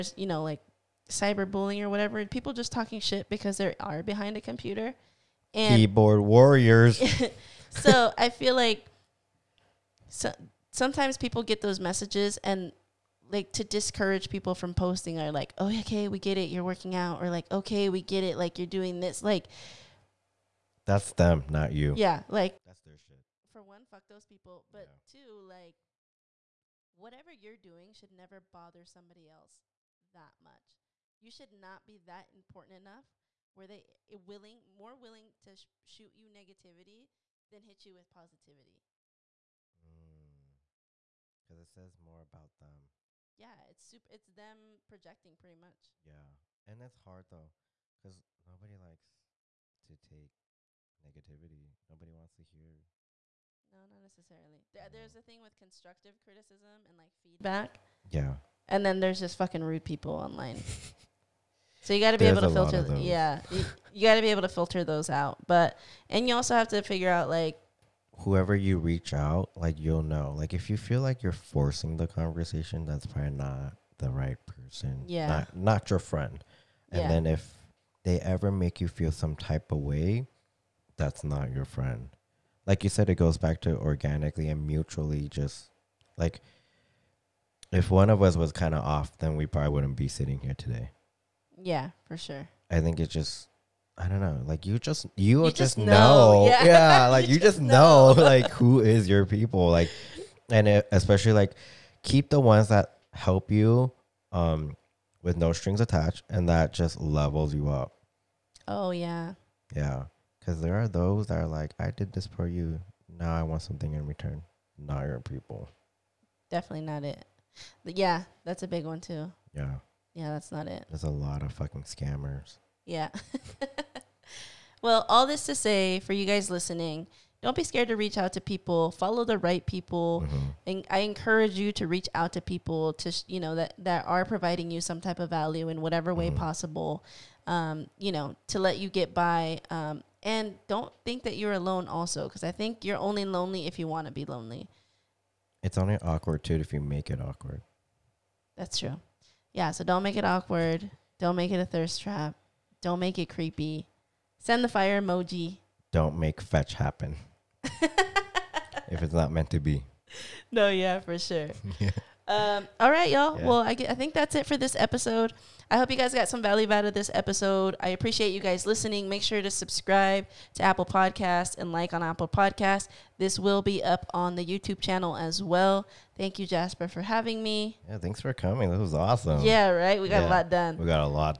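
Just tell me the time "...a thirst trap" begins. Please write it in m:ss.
2:31.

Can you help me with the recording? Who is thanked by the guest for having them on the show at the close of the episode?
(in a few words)
Jasper.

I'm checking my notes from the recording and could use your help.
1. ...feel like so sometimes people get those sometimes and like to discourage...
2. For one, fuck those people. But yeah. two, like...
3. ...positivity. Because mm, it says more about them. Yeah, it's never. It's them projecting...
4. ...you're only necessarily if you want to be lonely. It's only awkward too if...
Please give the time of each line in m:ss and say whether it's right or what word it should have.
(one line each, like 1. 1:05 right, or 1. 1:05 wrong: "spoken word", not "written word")
1. 0:08 wrong: "messages", not "sometimes"
2. 0:23 right
3. 0:38 wrong: "super", not "never"
4. 2:22 wrong: "lonely", not "necessarily".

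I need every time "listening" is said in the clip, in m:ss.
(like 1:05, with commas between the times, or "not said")
2:06, 2:48.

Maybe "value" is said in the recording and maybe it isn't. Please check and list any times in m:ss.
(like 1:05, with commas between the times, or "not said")
2:15, 2:46.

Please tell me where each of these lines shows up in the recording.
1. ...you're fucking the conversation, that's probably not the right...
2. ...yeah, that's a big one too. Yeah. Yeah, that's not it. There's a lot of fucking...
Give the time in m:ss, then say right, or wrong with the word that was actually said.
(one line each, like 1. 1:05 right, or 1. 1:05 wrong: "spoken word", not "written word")
1. 1:11 wrong: "forcing", not "fucking"
2. 1:57 right.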